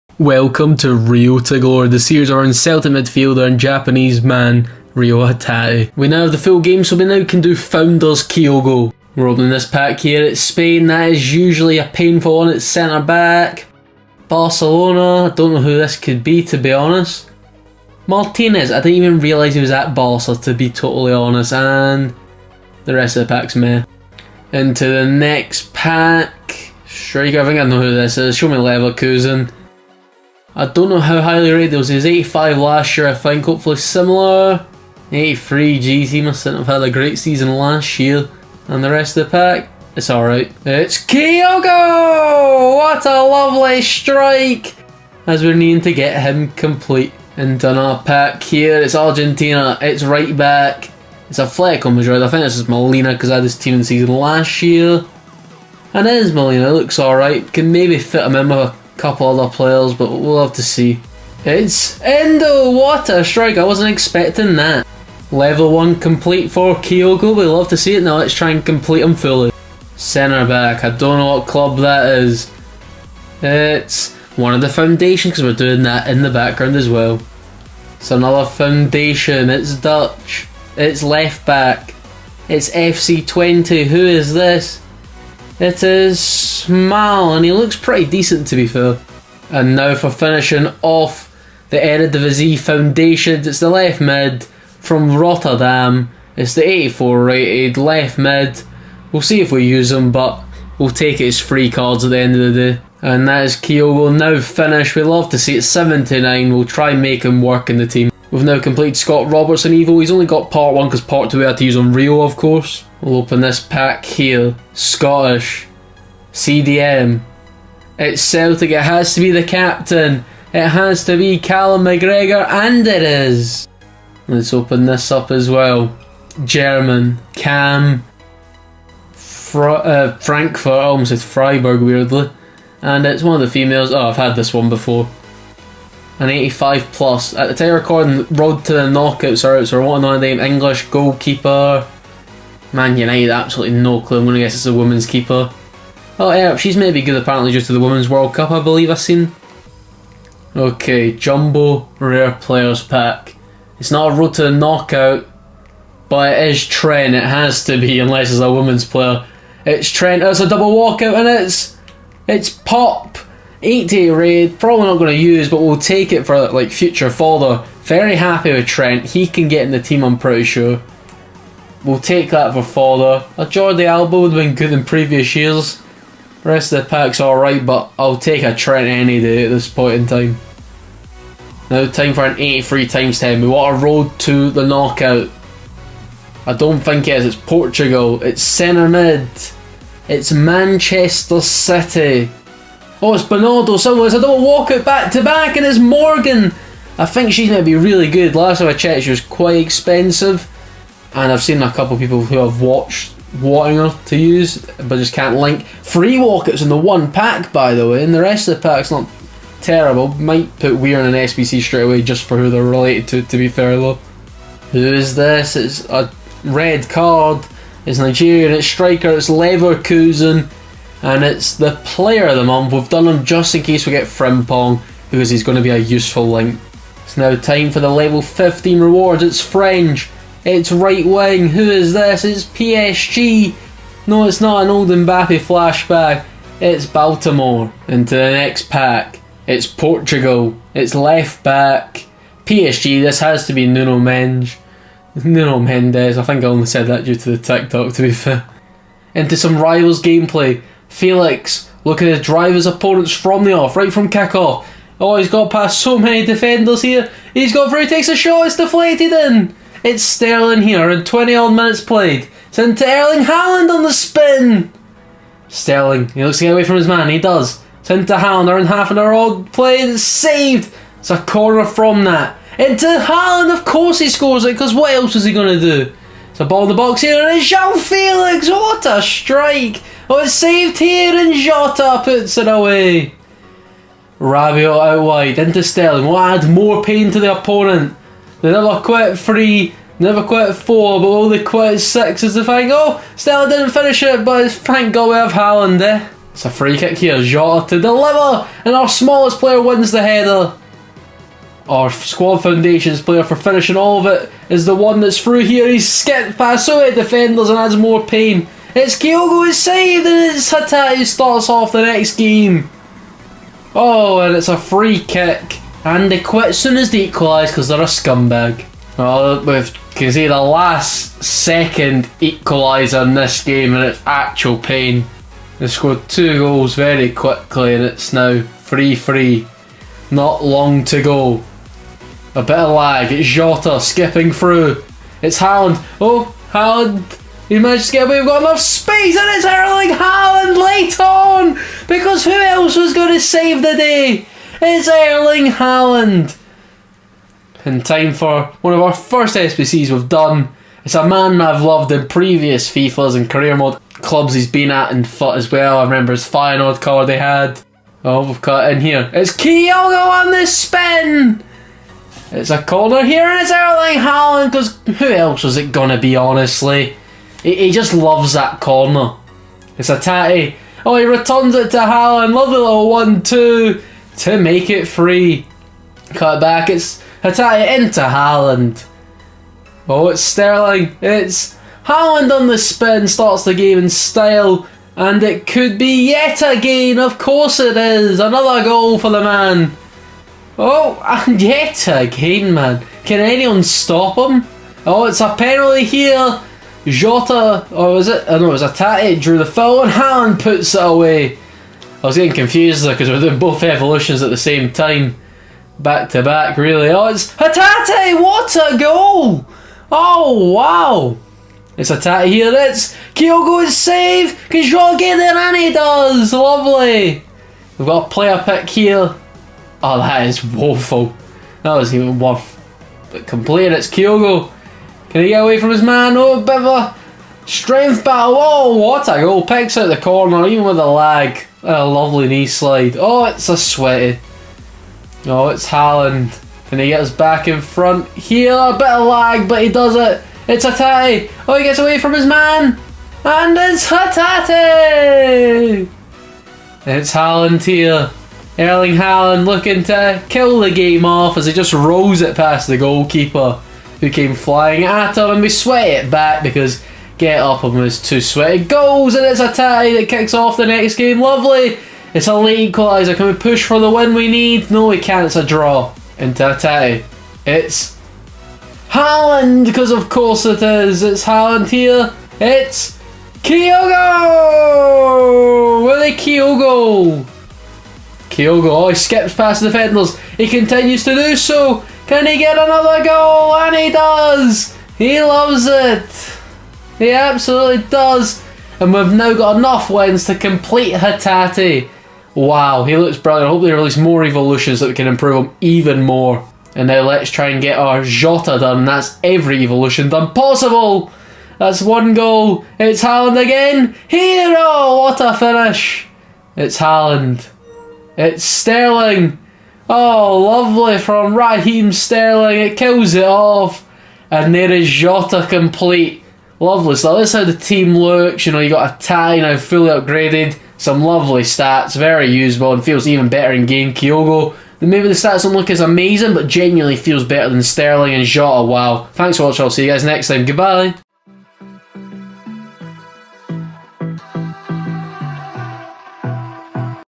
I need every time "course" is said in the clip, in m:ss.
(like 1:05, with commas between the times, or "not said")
1:52, 4:33, 6:27, 7:50.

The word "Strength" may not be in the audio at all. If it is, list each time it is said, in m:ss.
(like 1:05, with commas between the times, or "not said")
7:07.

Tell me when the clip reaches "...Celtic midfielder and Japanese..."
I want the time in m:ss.
0:02.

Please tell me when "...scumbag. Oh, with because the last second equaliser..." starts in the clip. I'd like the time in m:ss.
5:17.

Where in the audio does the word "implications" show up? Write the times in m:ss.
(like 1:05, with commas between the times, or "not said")
not said.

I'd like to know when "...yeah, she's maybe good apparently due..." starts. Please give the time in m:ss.
2:26.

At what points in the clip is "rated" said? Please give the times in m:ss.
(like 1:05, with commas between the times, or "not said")
0:31, 1:37.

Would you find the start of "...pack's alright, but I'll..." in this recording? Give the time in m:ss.
2:56.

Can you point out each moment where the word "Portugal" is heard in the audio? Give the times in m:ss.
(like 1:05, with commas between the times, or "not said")
3:07, 3:59.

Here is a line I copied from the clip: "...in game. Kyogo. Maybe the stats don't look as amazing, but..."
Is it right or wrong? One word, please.
right.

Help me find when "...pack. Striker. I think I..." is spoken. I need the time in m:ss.
0:25.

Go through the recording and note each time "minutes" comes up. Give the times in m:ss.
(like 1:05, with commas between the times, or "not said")
4:21.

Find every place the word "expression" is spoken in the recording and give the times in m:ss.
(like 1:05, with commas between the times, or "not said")
not said.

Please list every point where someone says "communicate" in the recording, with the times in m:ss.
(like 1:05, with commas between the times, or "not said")
not said.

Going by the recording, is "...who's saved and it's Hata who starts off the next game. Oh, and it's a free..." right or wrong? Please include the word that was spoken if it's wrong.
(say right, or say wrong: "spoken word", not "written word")
right.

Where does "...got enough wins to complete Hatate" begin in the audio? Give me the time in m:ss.
8:09.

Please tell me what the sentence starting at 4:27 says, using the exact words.
It's into Haaland and half an hour old played, it's saved!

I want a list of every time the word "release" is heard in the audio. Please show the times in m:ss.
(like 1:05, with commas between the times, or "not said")
8:13.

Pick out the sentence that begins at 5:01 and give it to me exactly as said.
Our squad foundations player for finishing all of it is the one that's through here.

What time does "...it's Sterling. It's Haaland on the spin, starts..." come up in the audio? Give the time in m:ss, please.
6:20.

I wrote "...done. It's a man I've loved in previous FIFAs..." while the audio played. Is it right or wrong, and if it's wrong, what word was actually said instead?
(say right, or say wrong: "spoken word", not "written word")
right.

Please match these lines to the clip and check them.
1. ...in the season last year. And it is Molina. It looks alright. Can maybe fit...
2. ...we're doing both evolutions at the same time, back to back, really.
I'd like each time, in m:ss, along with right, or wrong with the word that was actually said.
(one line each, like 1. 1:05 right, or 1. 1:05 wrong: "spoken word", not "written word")
1. 0:53 right
2. 6:43 right.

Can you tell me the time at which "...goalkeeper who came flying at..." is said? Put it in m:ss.
7:32.